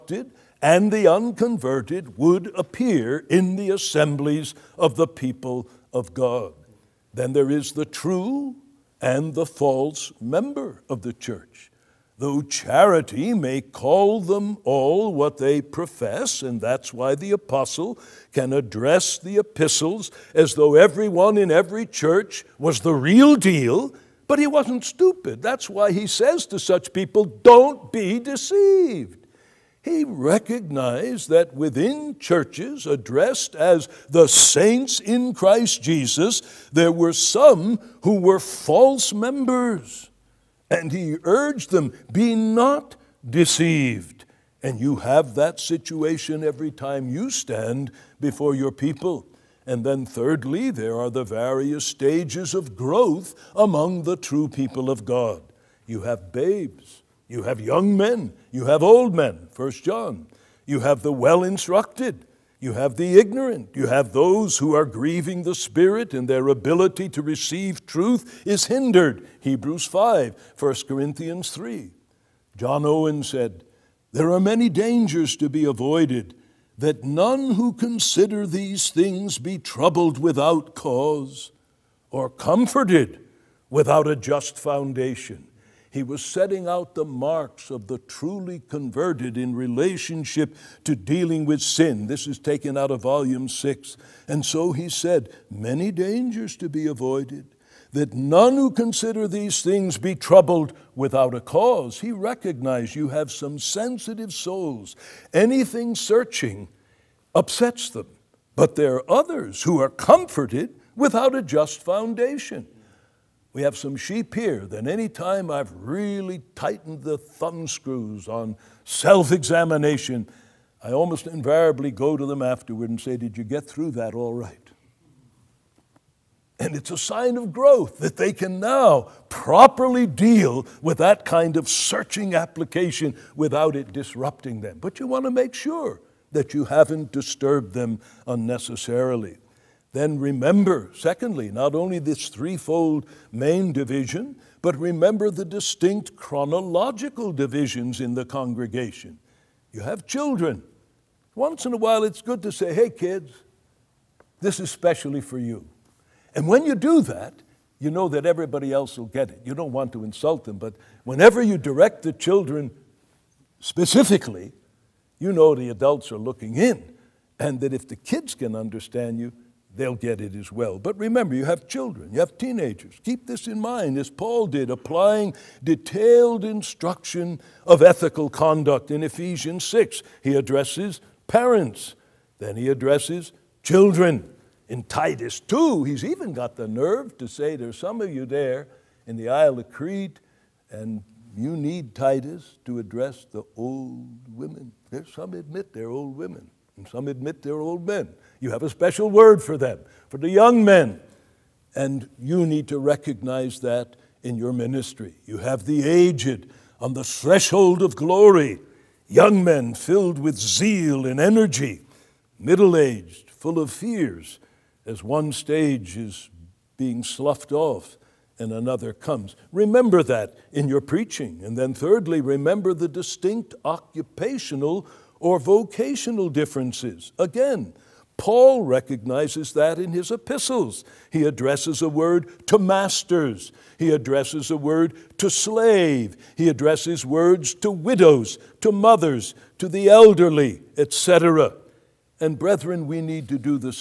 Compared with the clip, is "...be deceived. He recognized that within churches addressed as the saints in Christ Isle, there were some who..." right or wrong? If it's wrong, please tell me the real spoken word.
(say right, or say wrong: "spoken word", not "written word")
wrong: "Jesus", not "Isle".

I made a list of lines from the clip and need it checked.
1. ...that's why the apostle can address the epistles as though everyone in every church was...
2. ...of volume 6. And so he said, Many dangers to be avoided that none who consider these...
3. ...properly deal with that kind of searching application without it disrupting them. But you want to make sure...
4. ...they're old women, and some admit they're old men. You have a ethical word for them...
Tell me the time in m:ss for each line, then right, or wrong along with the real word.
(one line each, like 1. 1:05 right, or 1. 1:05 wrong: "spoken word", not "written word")
1. 0:16 right
2. 1:32 right
3. 2:09 right
4. 3:15 wrong: "special", not "ethical".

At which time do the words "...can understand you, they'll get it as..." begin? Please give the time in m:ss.
2:48.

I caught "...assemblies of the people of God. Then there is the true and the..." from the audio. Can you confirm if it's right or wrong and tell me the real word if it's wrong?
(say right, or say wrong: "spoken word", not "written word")
right.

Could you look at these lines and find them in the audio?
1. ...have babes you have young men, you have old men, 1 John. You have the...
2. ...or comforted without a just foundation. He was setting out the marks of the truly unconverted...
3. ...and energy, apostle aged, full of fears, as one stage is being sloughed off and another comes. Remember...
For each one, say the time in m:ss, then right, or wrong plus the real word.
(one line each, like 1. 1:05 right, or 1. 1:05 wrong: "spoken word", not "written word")
1. 0:56 right
2. 1:22 wrong: "converted", not "unconverted"
3. 3:31 wrong: "middle", not "apostle".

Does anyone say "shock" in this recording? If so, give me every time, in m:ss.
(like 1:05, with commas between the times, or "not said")
not said.